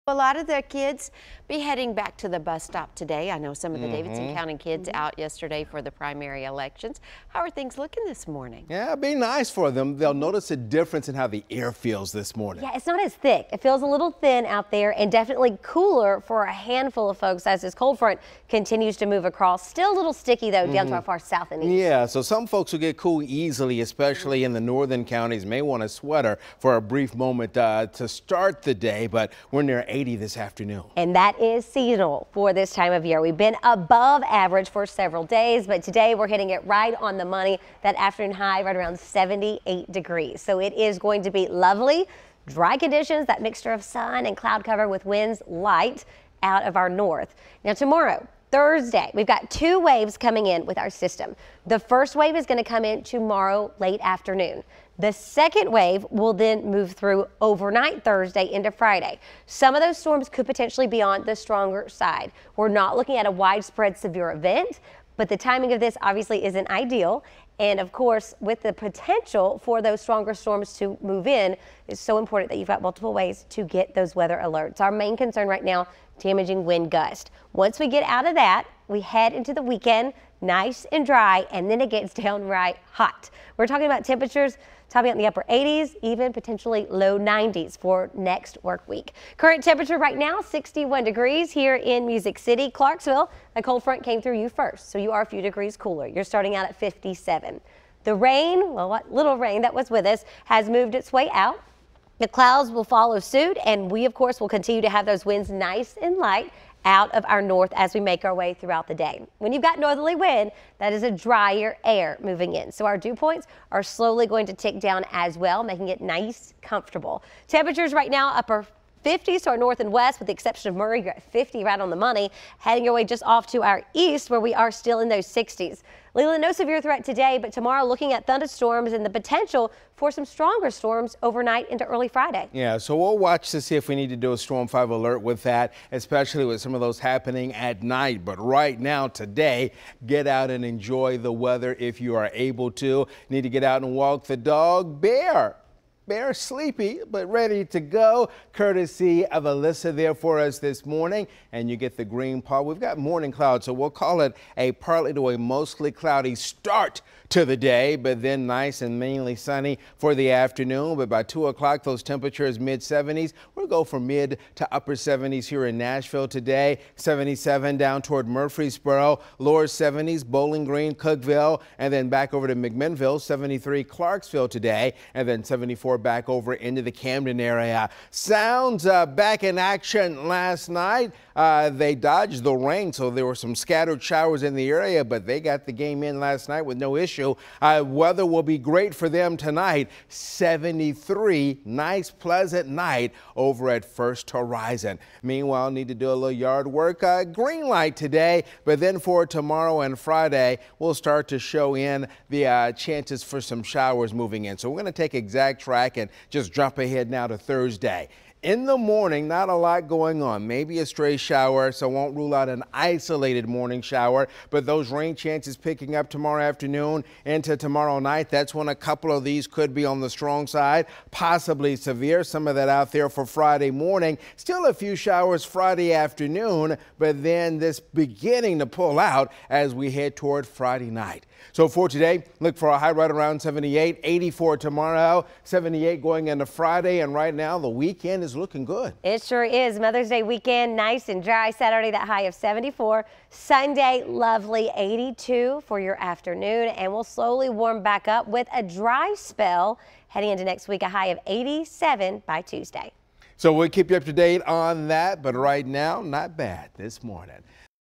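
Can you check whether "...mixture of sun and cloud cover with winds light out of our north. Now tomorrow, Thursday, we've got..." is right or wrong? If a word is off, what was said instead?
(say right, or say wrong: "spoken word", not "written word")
right.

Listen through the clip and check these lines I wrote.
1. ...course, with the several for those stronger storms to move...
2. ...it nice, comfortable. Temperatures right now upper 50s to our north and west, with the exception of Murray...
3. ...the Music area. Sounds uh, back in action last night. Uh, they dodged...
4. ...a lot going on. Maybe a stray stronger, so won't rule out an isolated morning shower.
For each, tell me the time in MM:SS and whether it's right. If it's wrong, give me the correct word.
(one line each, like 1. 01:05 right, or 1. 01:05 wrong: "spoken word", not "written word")
1. 01:07 wrong: "potential", not "several"
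2. 01:55 right
3. 02:56 wrong: "Camden", not "Music"
4. 03:29 wrong: "shower", not "stronger".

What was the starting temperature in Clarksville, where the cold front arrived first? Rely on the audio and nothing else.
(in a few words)
57.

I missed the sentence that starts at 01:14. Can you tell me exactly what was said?
Our main concern right now, damaging wind gust.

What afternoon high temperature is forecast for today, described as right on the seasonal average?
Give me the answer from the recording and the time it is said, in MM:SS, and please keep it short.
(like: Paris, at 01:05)
78 degrees, at 00:38.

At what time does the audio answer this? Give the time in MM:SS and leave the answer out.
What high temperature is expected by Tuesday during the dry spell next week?
04:11.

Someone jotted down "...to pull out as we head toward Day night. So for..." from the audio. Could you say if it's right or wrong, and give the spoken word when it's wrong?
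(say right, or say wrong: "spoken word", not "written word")
wrong: "Friday", not "Day".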